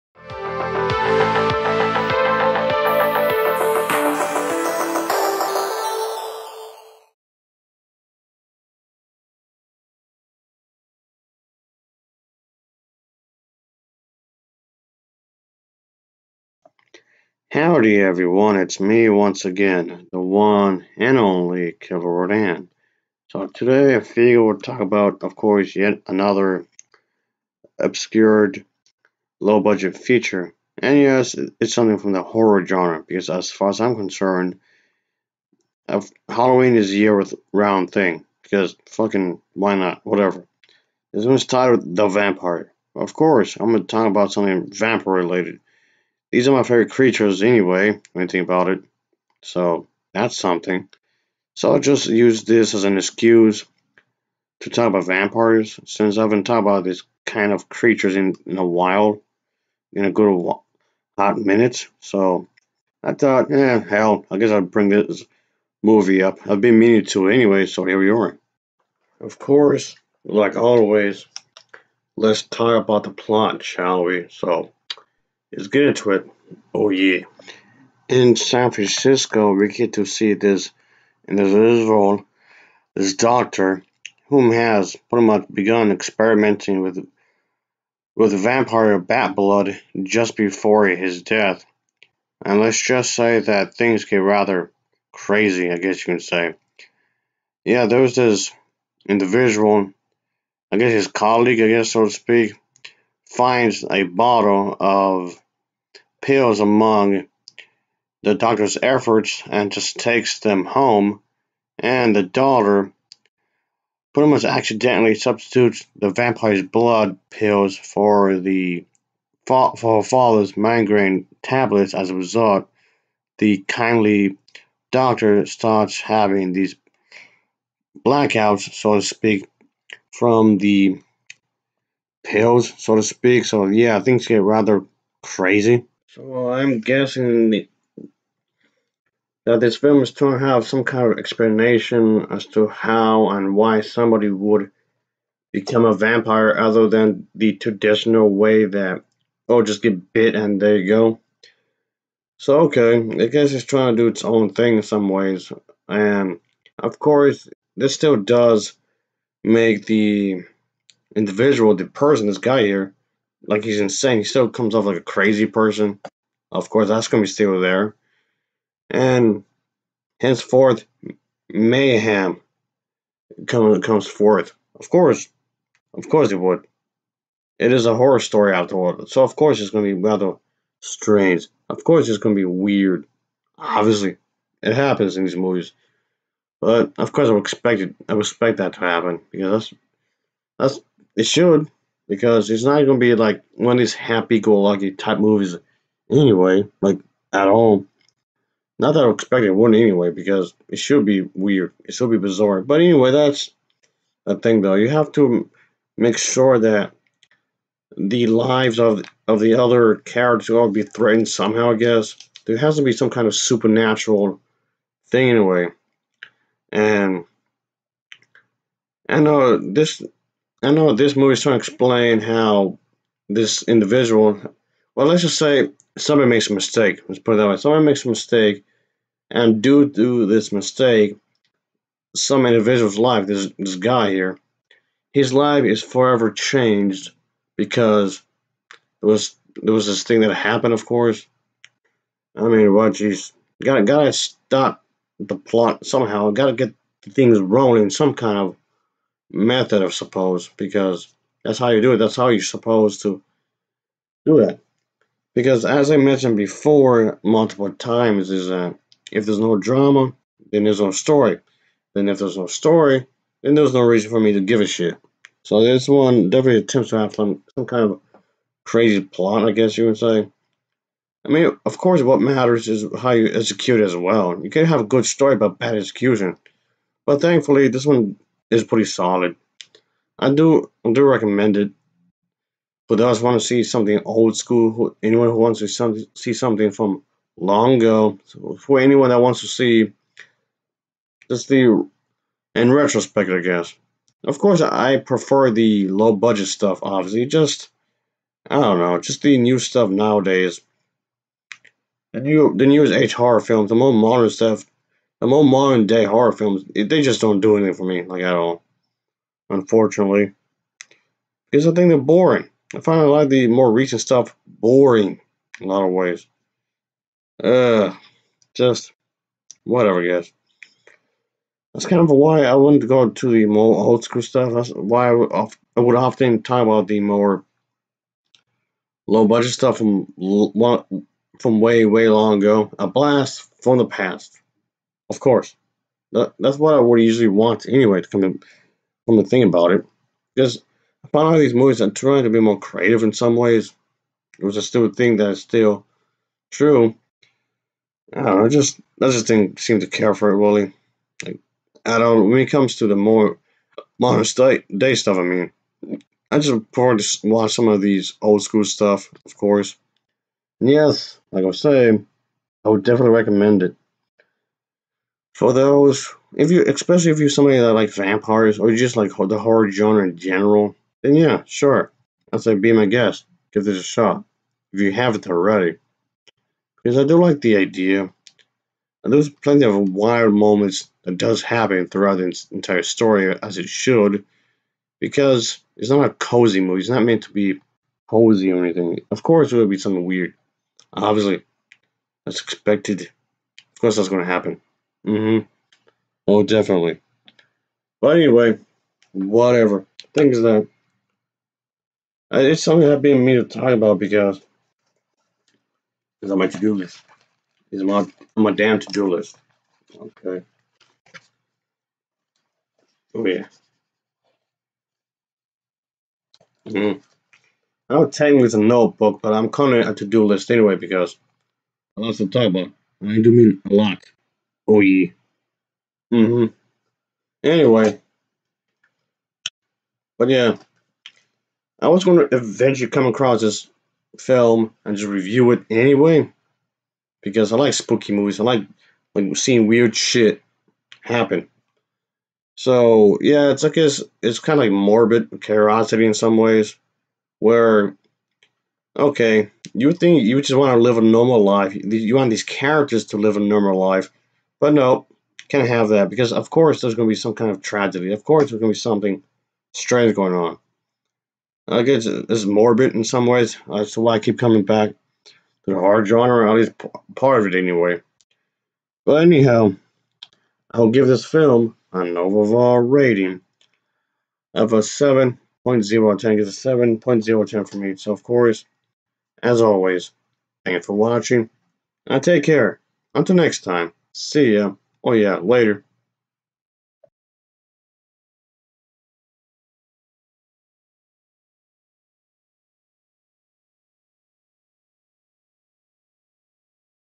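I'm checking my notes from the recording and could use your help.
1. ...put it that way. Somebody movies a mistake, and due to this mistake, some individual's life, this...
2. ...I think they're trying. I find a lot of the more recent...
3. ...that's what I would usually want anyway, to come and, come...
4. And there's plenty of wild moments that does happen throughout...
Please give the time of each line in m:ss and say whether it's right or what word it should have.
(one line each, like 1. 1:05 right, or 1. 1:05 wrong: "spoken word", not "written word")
1. 3:47 wrong: "makes", not "movies"
2. 5:11 wrong: "boring", not "trying"
3. 5:36 right
4. 6:19 right.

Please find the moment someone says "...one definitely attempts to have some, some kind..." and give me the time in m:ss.
4:25.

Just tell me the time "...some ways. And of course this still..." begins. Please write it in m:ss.
2:34.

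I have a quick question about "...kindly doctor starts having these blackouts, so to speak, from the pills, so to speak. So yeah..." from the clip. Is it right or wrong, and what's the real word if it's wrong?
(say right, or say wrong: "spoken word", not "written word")
right.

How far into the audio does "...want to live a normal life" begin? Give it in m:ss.
7:30.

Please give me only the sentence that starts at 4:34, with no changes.
You can have a good story, but bad execution.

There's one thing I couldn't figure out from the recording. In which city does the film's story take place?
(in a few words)
San Francisco.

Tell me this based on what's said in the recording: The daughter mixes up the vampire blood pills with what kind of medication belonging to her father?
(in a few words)
migraine tablets.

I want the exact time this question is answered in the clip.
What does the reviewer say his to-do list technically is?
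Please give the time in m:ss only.
6:58.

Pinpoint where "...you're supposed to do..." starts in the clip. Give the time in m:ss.
4:12.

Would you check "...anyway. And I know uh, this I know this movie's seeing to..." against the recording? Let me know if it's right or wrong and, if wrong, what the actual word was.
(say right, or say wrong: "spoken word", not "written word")
wrong: "trying", not "seeing".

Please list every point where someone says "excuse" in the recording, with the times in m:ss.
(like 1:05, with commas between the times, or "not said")
0:52.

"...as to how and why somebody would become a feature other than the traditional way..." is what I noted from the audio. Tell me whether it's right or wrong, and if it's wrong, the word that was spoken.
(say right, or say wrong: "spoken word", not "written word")
wrong: "vampire", not "feature".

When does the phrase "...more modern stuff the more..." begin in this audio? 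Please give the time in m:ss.
5:03.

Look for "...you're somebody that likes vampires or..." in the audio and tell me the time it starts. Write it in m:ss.
6:07.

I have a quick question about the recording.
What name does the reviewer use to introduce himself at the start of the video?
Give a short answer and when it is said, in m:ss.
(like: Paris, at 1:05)
Killer Rodan, at 0:21.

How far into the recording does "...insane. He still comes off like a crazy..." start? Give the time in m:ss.
2:43.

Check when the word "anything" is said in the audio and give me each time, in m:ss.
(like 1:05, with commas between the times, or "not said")
5:07, 6:28.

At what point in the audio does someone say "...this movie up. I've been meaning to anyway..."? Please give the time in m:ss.
1:04.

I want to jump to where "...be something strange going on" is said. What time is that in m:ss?
7:38.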